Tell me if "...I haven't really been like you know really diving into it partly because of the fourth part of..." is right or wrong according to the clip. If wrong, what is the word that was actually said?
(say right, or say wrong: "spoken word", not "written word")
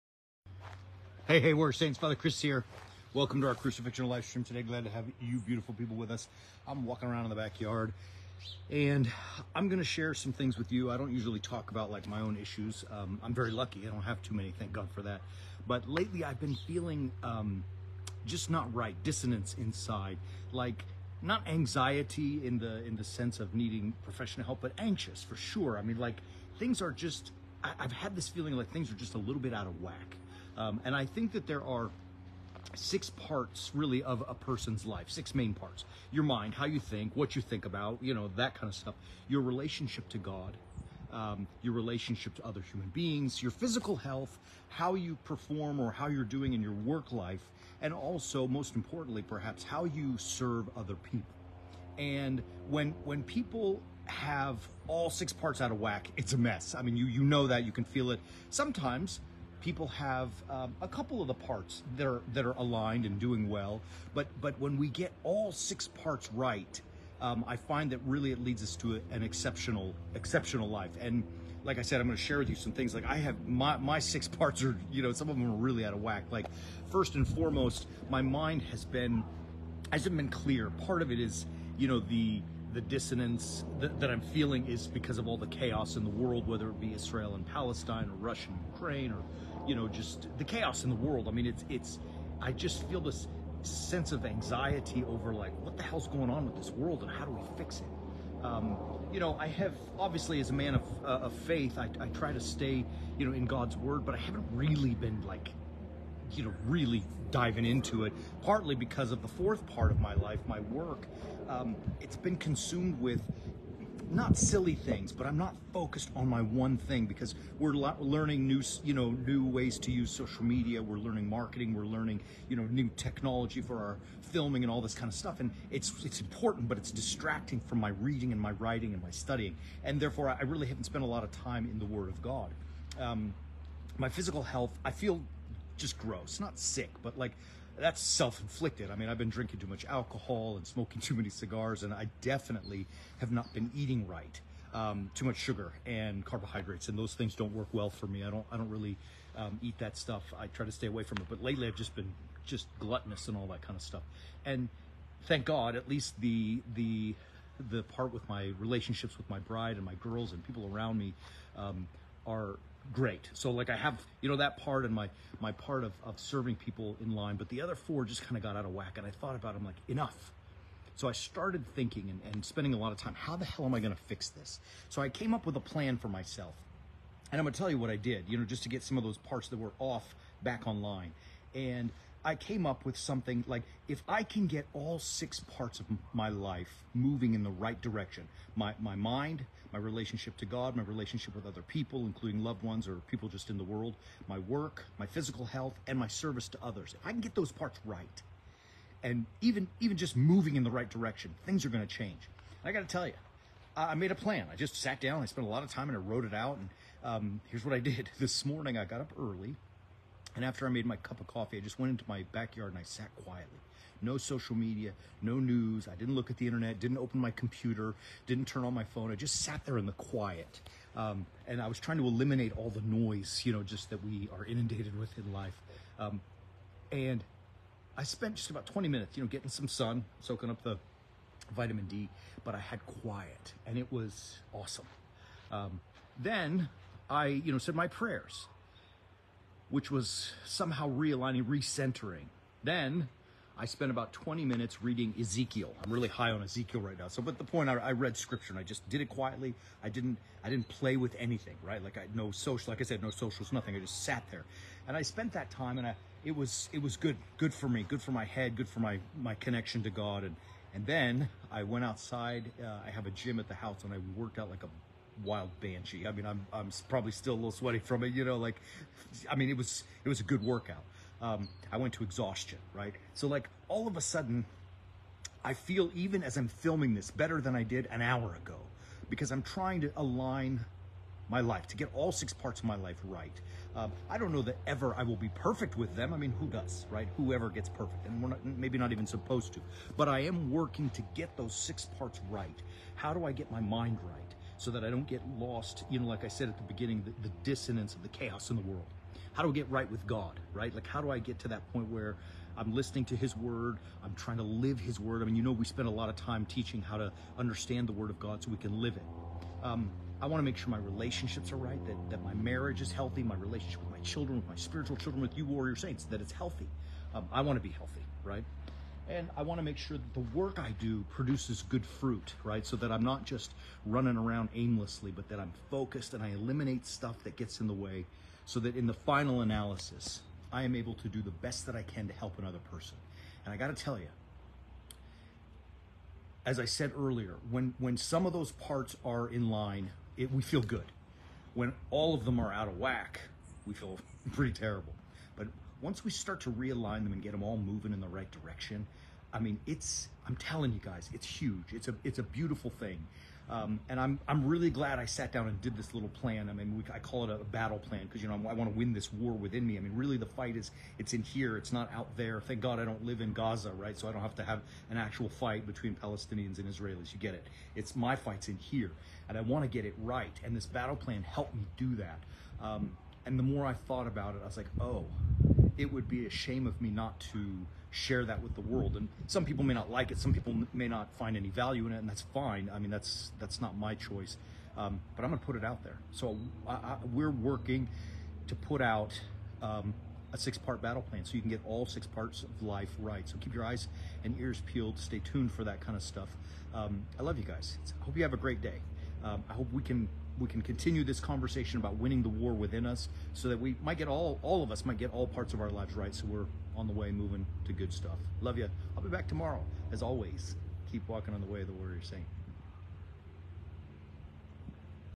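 right.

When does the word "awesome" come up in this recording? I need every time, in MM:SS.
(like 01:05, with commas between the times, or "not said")
03:54.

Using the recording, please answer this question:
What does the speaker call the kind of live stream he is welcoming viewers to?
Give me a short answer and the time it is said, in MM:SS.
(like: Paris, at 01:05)
crucifixion live stream, at 00:03.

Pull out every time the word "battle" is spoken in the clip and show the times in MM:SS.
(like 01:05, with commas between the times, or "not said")
05:57, 06:10, 06:30.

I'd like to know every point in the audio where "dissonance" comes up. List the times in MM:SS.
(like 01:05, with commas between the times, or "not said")
00:19, 01:22, 04:57.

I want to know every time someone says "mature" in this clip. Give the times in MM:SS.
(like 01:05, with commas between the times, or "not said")
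not said.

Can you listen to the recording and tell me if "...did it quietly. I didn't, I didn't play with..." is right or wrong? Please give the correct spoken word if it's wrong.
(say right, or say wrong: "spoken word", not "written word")
right.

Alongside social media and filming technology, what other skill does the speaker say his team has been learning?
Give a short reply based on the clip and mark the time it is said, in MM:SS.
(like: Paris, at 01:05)
marketing, at 02:01.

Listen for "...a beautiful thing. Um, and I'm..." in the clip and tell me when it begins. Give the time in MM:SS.
05:52.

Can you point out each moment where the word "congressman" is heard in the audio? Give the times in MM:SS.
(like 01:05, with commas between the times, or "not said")
not said.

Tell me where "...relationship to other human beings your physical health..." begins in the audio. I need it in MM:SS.
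00:41.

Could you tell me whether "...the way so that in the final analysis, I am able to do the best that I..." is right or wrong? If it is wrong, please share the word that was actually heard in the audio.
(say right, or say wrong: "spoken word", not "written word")
right.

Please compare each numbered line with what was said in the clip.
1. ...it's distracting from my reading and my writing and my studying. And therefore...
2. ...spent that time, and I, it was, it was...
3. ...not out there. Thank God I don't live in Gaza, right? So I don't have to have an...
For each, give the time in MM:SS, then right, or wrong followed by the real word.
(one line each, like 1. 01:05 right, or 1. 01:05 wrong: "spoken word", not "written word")
1. 02:06 right
2. 04:15 right
3. 06:01 right.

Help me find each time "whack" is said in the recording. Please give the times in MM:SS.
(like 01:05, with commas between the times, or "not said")
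00:29, 00:55, 01:16, 02:48, 05:42.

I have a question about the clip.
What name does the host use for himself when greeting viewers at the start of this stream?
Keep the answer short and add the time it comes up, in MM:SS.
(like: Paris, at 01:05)
Father Chris, at 00:01.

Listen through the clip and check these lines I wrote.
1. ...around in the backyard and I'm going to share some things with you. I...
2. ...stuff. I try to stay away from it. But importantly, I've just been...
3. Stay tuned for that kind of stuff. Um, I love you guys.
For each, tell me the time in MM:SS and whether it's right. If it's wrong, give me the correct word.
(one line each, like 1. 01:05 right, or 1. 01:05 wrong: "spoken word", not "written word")
1. 00:07 right
2. 02:29 wrong: "lately", not "importantly"
3. 06:34 right.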